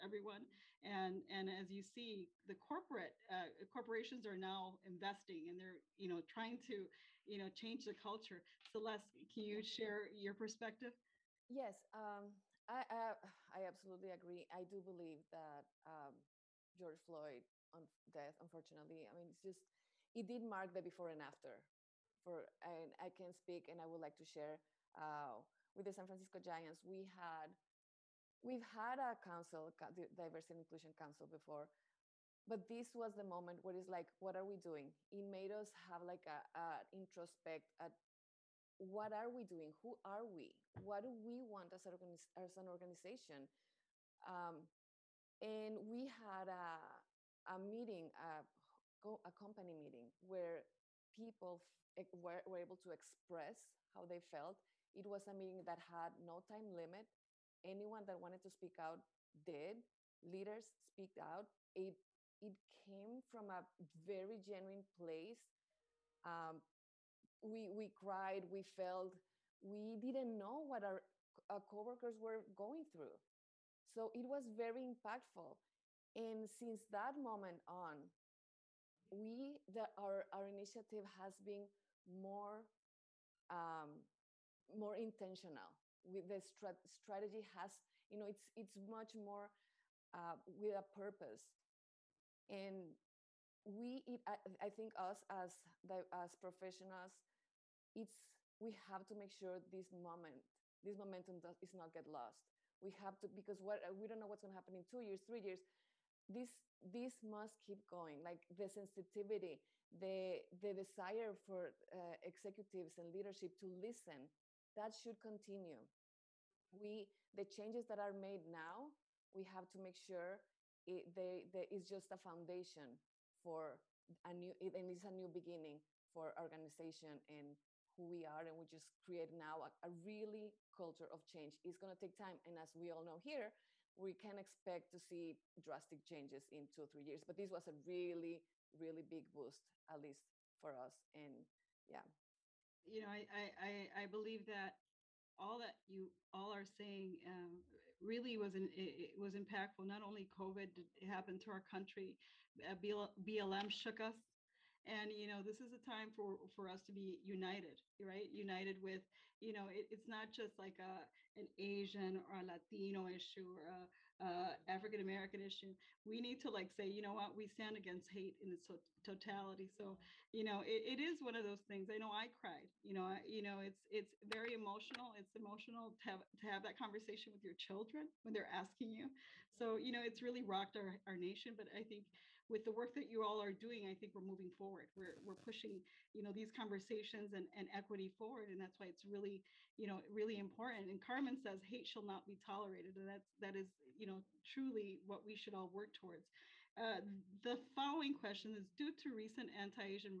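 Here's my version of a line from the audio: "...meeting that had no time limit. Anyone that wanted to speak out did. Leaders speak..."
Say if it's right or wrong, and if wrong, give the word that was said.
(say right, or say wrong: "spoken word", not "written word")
right.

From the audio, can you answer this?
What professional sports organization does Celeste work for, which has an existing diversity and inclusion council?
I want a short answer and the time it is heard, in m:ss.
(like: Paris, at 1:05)
San Francisco Giants, at 0:25.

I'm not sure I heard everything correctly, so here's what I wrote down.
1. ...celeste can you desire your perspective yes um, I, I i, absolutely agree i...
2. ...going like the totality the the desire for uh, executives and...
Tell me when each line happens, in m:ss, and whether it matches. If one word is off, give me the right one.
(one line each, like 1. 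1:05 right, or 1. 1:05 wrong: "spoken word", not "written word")
1. 0:08 wrong: "share", not "desire"
2. 1:47 wrong: "sensitivity", not "totality".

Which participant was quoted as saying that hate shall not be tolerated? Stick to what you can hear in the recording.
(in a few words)
Carmen.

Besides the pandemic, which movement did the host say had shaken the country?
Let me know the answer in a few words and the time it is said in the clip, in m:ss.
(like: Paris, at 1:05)
BLM, at 2:32.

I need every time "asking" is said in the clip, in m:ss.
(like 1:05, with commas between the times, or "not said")
2:58.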